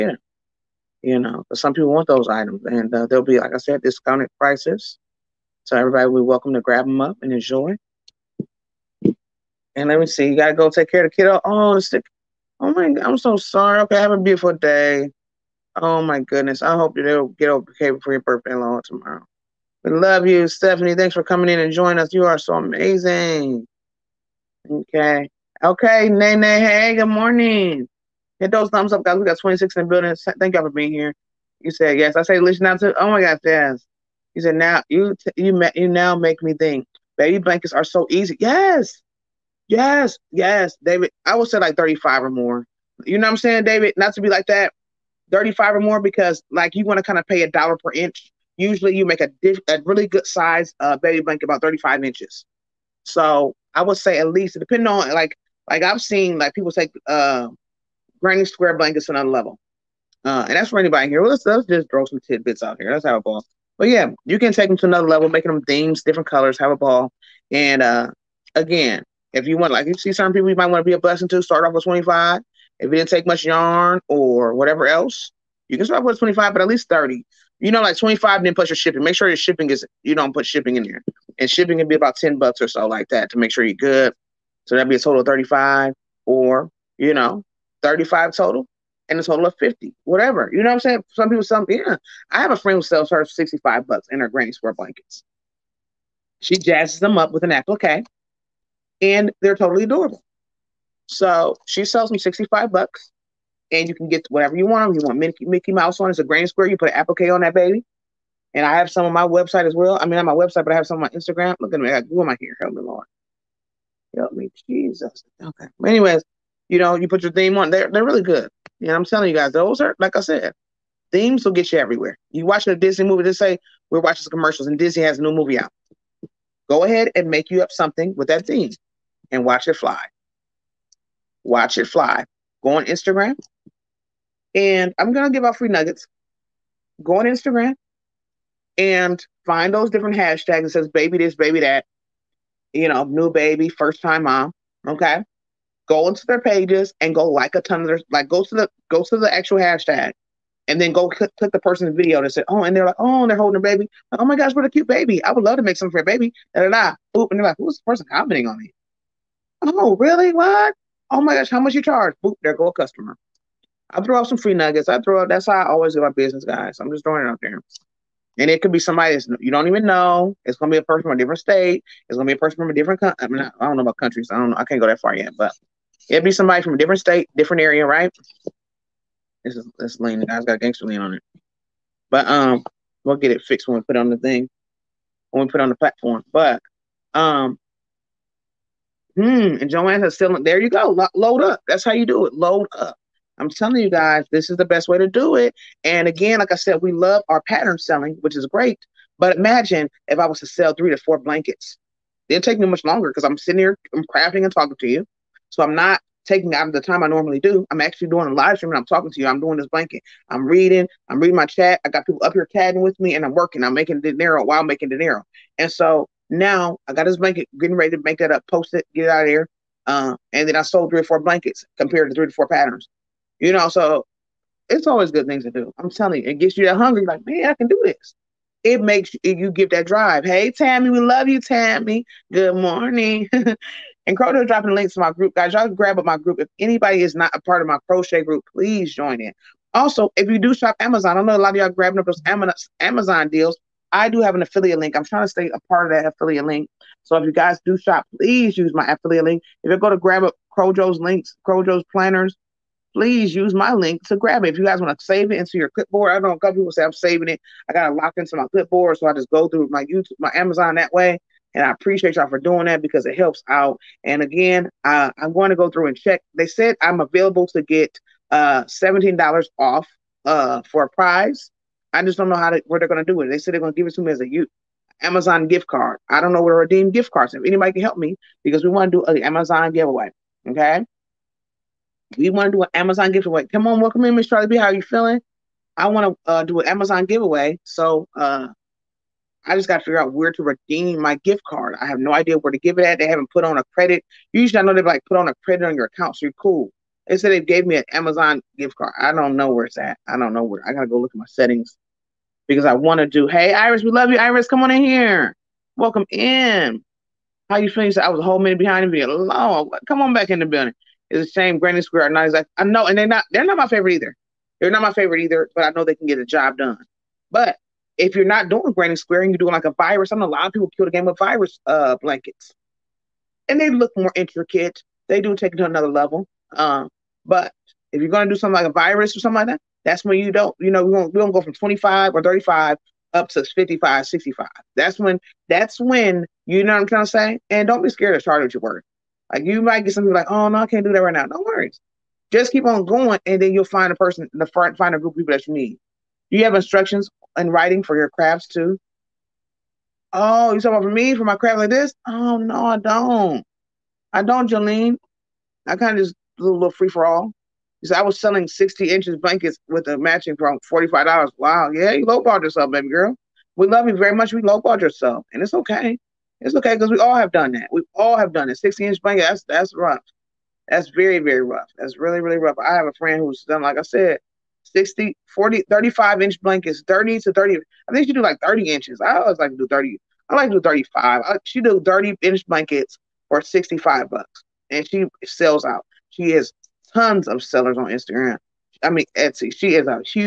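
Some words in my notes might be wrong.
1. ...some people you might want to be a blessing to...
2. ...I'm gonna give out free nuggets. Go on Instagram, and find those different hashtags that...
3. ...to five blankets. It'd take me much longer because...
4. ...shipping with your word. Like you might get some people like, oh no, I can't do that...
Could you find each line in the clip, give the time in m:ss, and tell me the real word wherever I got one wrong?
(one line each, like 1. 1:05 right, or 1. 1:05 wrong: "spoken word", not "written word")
1. 1:10 right
2. 2:14 right
3. 3:20 wrong: "four", not "five"
4. 5:38 wrong: "starting", not "shipping".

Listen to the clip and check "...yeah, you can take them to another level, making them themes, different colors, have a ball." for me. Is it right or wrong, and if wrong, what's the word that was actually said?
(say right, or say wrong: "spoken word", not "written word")
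right.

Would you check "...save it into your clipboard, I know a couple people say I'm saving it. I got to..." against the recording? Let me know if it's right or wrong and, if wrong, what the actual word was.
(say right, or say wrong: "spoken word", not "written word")
right.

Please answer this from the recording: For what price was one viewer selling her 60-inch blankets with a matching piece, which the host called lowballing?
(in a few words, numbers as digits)
$45.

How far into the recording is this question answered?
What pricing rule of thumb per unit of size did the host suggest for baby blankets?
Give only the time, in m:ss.
0:47.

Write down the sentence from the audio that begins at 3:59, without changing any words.
Also, if you do shop Amazon, I know a lot of y'all grabbing up those Amazon deals.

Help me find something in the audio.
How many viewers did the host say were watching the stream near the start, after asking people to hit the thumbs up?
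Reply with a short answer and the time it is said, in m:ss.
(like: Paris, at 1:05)
26, at 0:29.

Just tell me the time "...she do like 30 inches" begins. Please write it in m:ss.
6:18.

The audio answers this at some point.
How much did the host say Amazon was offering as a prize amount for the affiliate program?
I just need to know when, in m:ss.
4:28.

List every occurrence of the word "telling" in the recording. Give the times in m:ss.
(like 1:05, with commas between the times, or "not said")
1:59, 3:13, 3:45.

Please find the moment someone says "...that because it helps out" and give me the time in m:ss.
4:22.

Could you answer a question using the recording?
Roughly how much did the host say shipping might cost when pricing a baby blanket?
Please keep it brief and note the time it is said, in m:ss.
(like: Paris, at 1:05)
10 bucks, at 1:22.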